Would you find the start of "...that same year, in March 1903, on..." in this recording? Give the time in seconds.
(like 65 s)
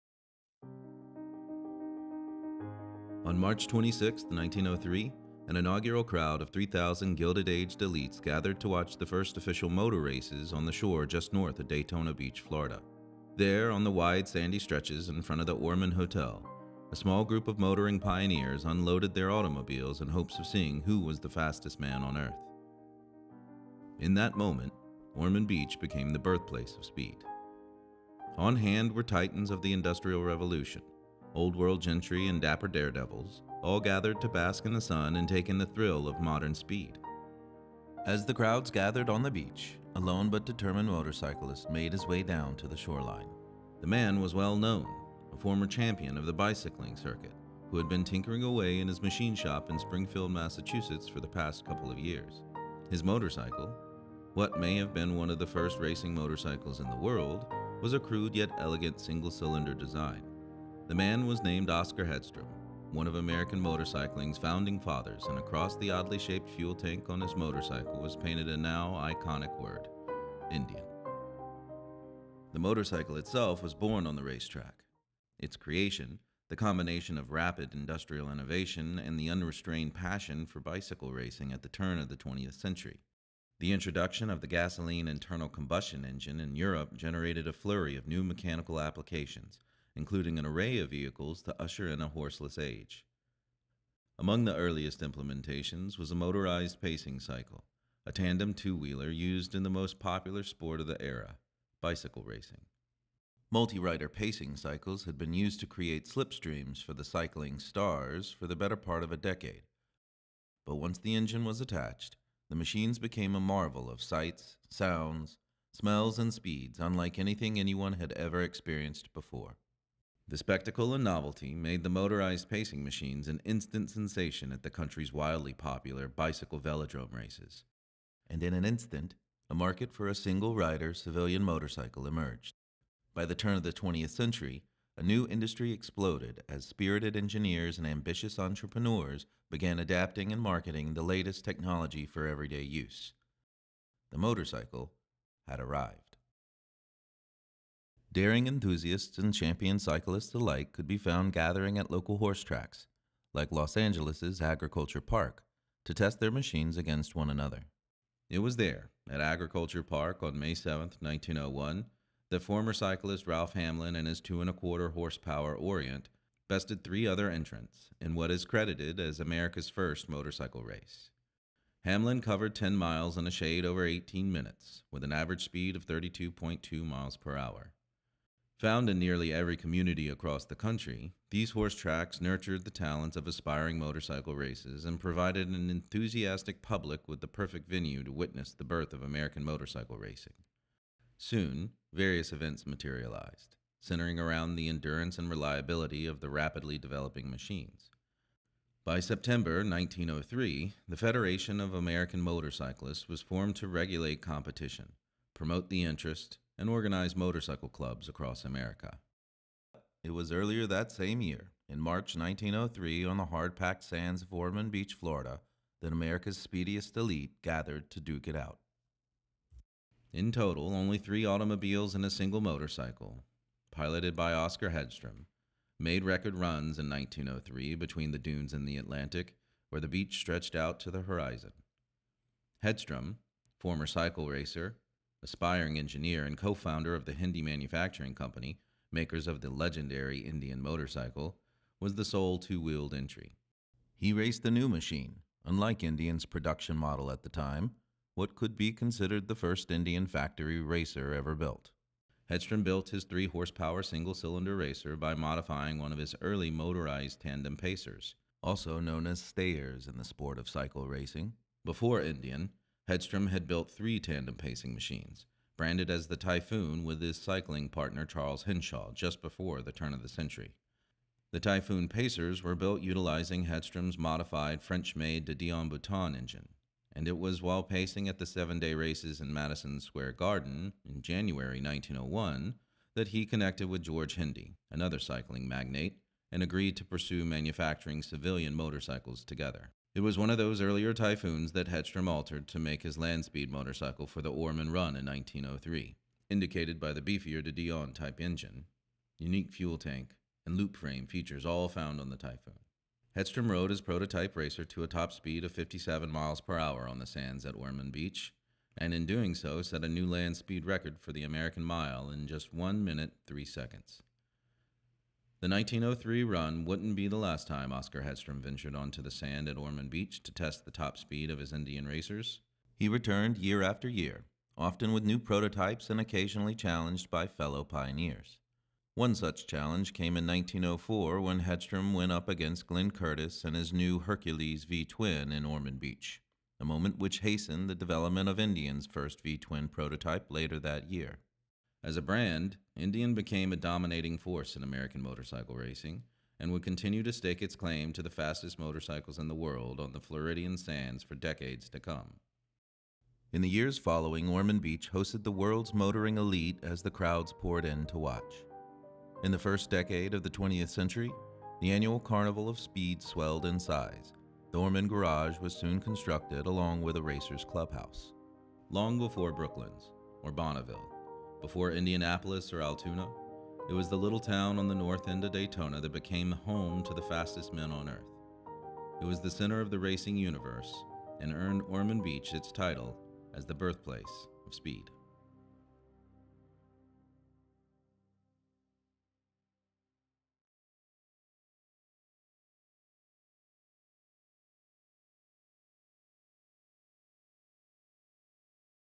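210 s.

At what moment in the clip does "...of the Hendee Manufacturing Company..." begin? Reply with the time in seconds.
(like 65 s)
236 s.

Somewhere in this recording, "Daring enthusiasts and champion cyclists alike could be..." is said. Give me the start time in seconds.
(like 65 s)
148 s.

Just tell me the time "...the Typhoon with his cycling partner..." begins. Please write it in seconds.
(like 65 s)
266 s.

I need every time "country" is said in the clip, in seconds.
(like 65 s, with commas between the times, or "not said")
124 s, 180 s.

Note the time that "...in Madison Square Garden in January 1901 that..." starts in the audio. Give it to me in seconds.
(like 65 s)
279 s.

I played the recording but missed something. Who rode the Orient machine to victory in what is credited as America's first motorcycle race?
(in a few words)
Ralph Hamlin.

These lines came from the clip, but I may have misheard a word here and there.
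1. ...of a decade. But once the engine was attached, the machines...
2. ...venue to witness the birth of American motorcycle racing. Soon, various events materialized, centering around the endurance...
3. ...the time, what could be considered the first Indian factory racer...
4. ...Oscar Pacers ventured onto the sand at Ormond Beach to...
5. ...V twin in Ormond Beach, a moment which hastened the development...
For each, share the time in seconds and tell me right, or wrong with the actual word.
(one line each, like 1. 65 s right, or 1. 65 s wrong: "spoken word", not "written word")
1. 109 s right
2. 187 s right
3. 247 s right
4. 317 s wrong: "Hedstrom", not "Pacers"
5. 334 s right.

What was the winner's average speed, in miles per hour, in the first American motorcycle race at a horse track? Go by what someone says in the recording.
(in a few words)
32.2.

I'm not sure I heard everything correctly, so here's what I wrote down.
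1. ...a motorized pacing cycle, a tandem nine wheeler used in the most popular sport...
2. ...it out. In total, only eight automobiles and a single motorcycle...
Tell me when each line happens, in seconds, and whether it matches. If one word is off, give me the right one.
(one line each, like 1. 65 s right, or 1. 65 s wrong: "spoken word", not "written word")
1. 96 s wrong: "two", not "nine"
2. 218 s wrong: "three", not "eight".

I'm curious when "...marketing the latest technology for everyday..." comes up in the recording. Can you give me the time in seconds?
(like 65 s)
140 s.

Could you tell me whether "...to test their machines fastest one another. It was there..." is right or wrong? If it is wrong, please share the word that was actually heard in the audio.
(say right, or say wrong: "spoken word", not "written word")
wrong: "against", not "fastest".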